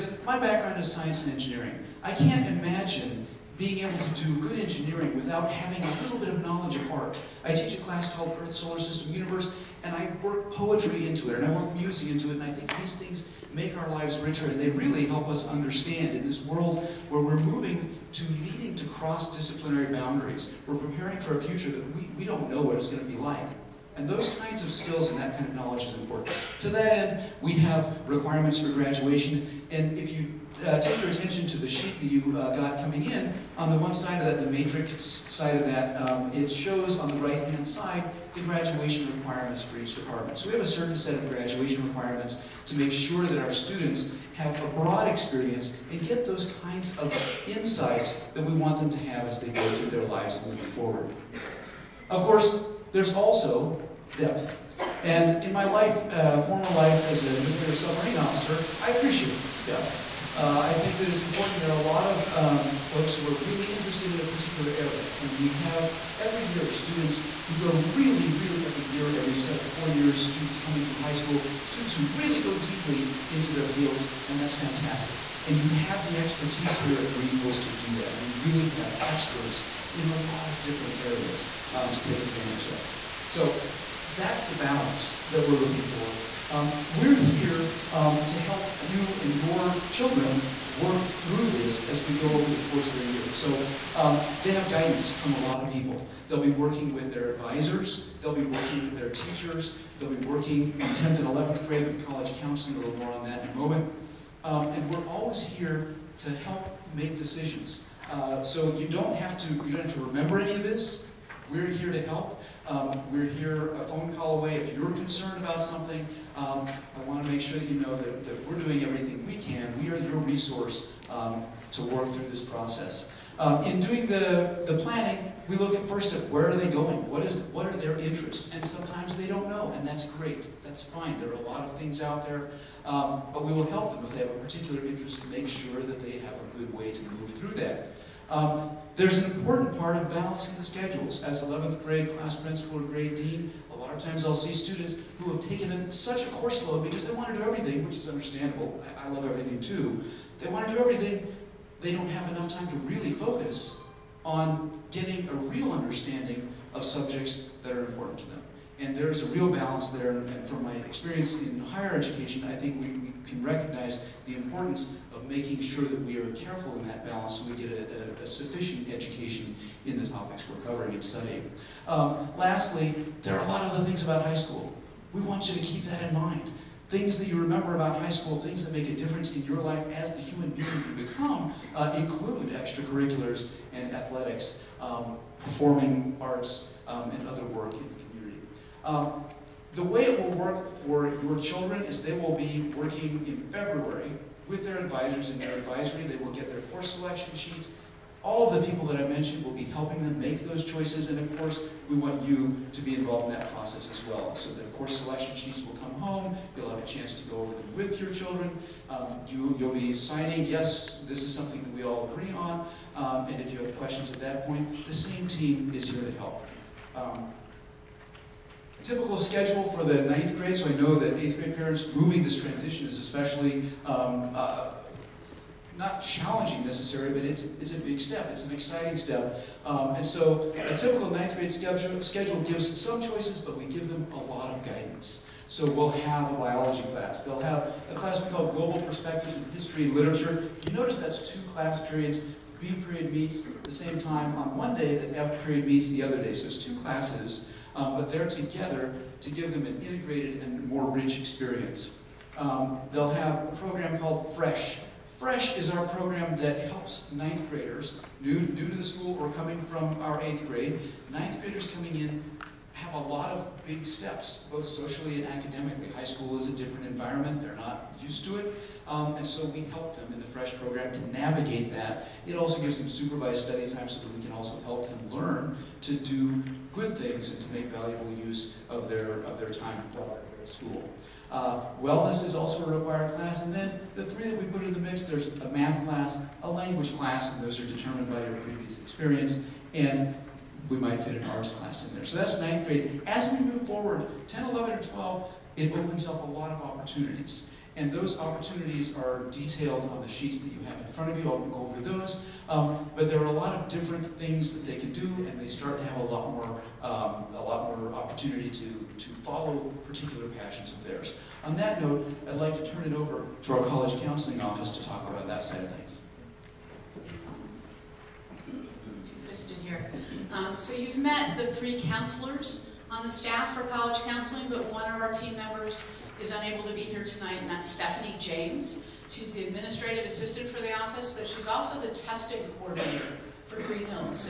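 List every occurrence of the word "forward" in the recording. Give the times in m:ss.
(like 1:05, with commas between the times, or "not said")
0:50, 4:53.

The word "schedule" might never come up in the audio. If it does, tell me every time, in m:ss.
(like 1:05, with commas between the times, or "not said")
2:20, 3:39, 3:51.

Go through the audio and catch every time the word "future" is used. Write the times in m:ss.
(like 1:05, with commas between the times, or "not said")
0:21.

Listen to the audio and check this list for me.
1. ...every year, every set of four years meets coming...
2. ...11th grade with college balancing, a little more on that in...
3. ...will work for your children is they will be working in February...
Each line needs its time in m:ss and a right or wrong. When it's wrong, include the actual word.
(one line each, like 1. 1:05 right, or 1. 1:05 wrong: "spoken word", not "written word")
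1. 1:08 wrong: "students", not "meets"
2. 1:41 wrong: "counseling", not "balancing"
3. 3:10 right.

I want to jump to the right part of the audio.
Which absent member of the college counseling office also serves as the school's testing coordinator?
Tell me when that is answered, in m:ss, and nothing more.
5:27.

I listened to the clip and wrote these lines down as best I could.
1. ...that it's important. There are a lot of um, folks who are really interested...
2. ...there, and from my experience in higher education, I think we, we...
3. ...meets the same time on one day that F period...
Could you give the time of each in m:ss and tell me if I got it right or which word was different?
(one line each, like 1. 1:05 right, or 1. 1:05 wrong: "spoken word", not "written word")
1. 1:00 right
2. 2:39 right
3. 4:03 right.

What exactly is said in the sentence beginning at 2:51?
Um, lastly, there are a lot of other things about high school.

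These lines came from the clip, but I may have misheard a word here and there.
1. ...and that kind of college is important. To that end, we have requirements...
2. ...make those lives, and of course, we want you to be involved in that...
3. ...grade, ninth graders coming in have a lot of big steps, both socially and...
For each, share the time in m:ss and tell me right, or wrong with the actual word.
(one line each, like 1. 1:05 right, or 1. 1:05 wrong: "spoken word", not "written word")
1. 0:25 wrong: "knowledge", not "college"
2. 3:20 wrong: "choices", not "lives"
3. 4:20 right.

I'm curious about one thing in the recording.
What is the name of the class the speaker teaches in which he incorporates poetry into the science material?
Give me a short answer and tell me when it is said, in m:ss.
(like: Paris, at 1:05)
Earth, Solar System, Universe, at 0:08.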